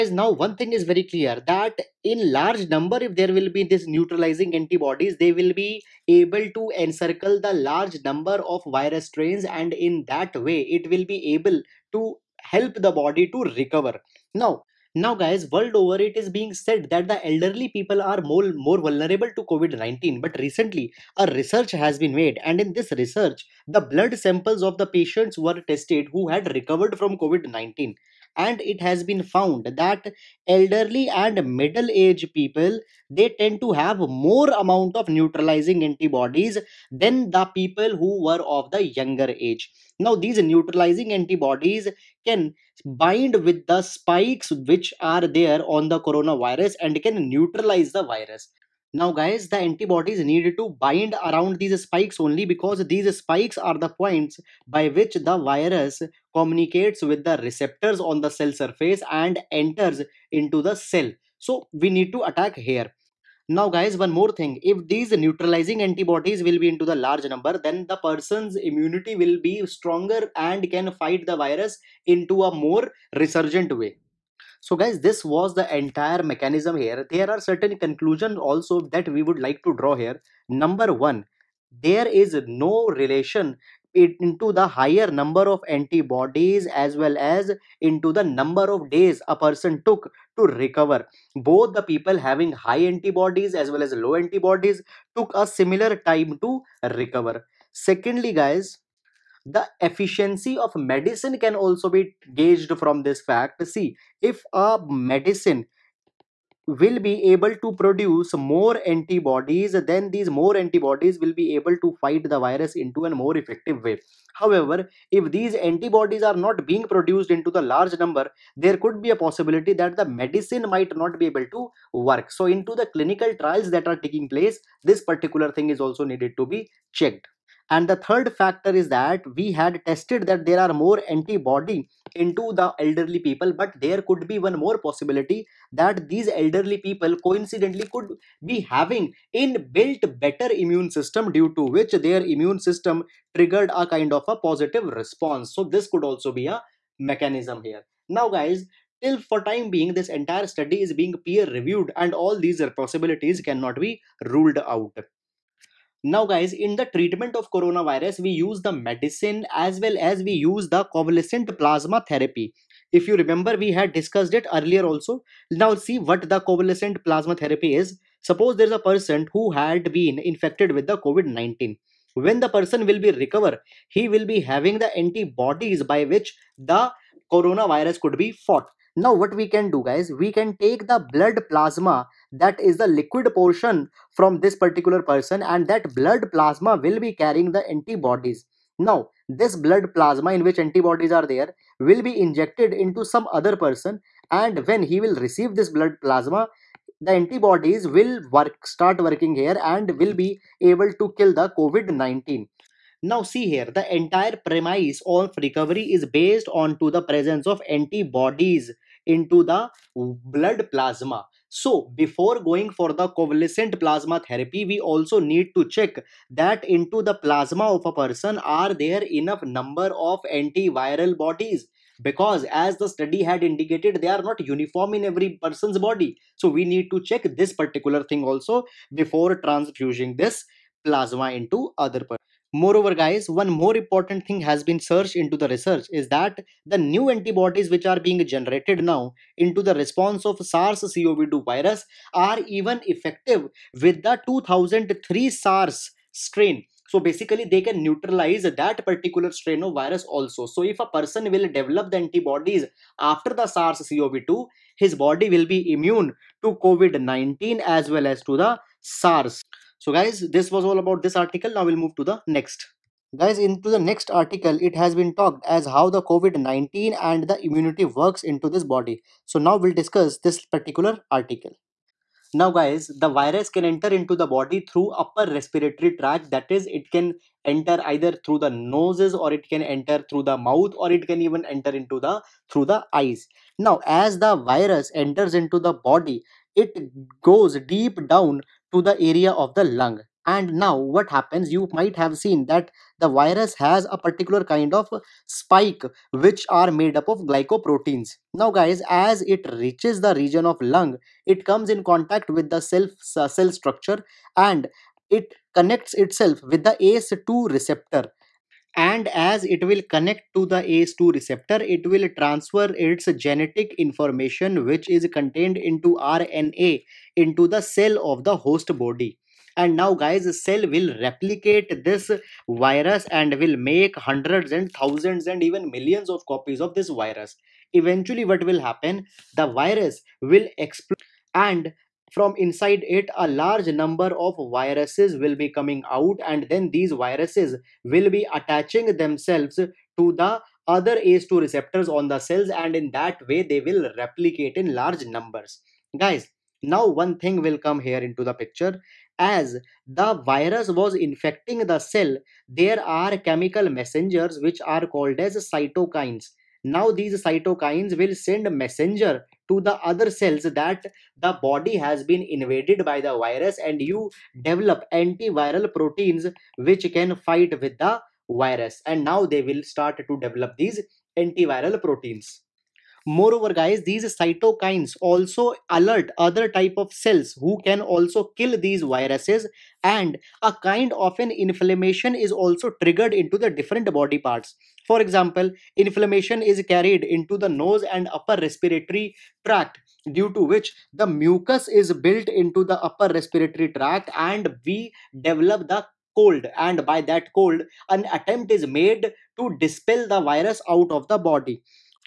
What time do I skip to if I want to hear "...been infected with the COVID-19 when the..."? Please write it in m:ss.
2:49.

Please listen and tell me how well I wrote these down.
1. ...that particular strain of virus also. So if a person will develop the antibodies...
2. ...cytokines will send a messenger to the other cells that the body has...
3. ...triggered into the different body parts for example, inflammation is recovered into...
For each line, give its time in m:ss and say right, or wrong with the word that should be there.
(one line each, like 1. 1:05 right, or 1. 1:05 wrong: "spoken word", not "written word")
1. 4:08 right
2. 5:57 right
3. 6:22 wrong: "carried", not "recovered".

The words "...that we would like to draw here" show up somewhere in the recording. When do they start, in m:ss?
1:18.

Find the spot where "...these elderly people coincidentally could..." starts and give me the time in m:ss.
2:16.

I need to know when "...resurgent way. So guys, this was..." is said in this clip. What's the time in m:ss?
1:13.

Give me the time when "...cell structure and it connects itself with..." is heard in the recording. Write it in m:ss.
5:03.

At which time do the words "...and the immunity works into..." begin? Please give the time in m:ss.
4:27.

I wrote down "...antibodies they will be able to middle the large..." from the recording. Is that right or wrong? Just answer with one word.
wrong.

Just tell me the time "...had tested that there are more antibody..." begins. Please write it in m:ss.
2:09.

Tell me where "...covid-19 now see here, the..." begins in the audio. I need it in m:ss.
3:21.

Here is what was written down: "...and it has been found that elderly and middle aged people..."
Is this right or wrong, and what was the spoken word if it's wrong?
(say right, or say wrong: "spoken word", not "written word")
right.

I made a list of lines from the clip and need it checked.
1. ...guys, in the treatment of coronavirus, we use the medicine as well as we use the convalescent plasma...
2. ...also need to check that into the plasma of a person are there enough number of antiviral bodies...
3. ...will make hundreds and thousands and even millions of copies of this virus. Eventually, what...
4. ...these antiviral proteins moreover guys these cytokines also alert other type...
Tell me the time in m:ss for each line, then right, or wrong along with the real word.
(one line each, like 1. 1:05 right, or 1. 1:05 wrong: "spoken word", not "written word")
1. 2:36 right
2. 3:34 right
3. 5:23 right
4. 6:10 right.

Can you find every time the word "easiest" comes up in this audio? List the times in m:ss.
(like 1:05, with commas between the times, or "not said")
not said.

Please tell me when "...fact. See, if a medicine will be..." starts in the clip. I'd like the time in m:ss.
1:43.